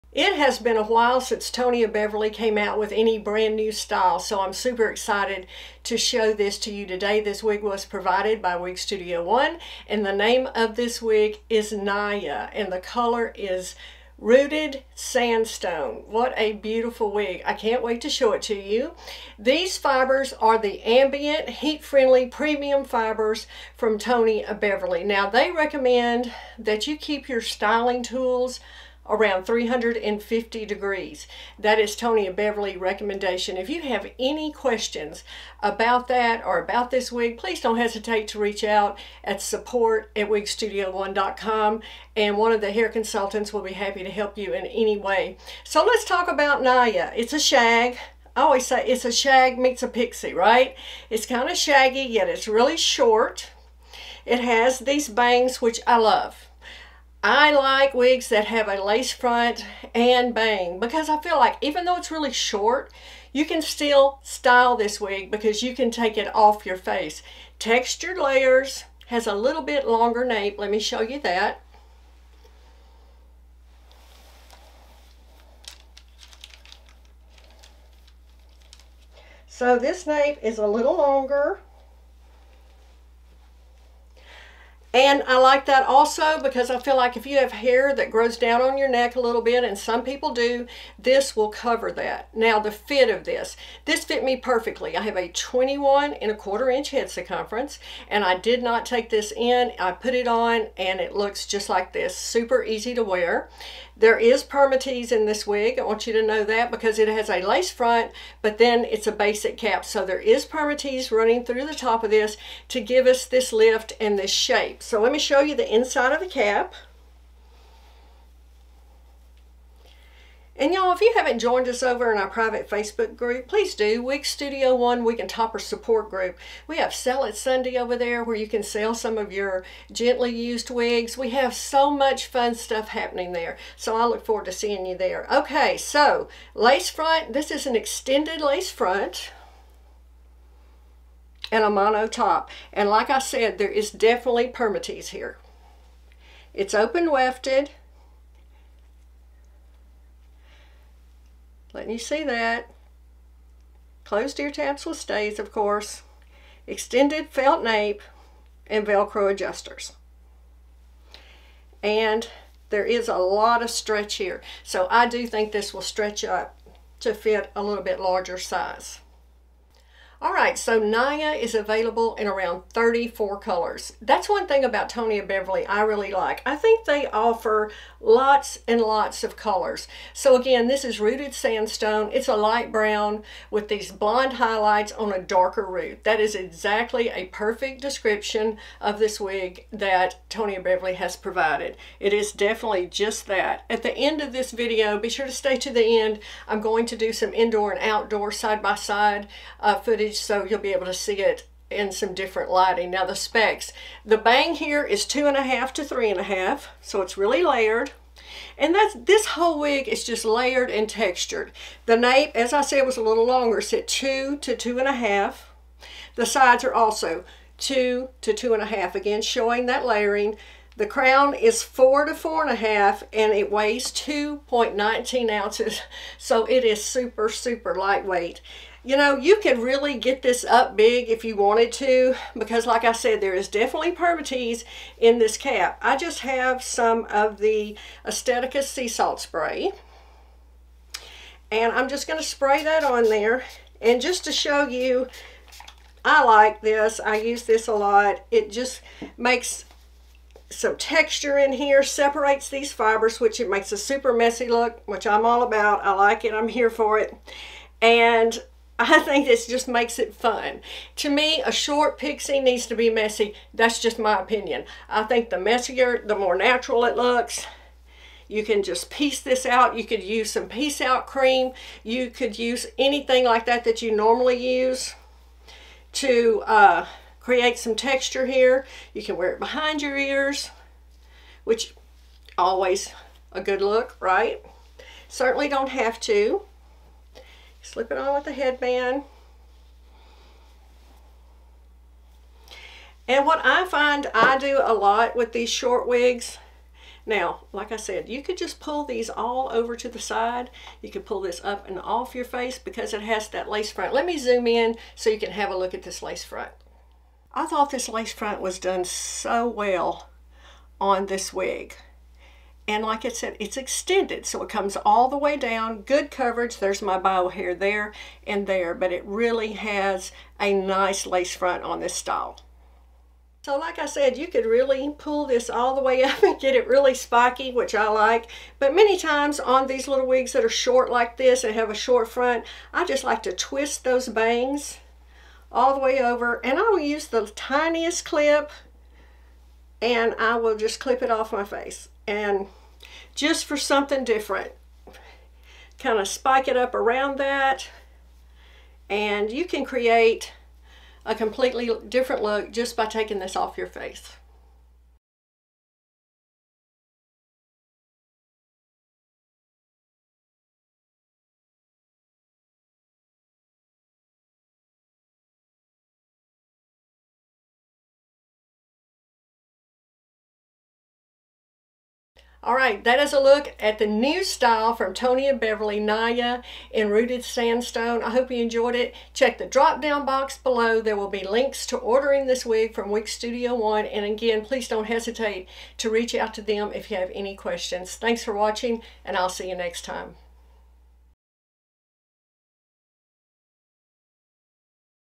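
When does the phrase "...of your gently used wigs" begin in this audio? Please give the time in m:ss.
2:09.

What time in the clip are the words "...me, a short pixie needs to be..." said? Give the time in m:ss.
4:21.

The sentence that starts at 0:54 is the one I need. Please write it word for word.
It has these bangs, which I love.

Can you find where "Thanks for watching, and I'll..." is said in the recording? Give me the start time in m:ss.
6:27.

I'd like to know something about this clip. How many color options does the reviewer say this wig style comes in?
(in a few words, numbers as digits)
34.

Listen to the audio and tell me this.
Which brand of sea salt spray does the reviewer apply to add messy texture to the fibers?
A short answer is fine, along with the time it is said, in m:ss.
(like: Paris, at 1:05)
Aesthetica, at 3:58.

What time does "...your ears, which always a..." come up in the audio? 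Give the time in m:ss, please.
4:39.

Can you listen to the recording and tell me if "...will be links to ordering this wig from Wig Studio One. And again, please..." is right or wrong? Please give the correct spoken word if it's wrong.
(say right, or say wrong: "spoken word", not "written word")
right.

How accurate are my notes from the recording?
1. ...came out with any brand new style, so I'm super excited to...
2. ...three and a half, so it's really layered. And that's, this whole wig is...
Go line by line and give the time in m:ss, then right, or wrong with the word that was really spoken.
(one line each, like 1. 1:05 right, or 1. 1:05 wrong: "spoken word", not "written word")
1. 0:02 right
2. 3:25 right.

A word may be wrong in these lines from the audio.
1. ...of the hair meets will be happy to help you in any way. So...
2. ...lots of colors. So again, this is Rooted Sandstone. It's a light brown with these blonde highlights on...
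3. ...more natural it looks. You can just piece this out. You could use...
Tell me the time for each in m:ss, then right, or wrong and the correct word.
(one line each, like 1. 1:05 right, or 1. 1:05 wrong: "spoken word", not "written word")
1. 0:42 wrong: "consultants", not "meets"
2. 2:58 right
3. 4:26 right.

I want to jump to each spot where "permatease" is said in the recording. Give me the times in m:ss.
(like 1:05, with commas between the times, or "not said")
1:44, 1:50, 2:24, 3:53.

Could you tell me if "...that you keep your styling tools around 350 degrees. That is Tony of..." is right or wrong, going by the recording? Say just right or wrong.
right.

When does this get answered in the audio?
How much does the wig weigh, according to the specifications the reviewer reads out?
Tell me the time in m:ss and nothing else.
3:43.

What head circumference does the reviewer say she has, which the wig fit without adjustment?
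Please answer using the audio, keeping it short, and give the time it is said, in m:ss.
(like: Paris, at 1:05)
21 and a quarter inches, at 1:35.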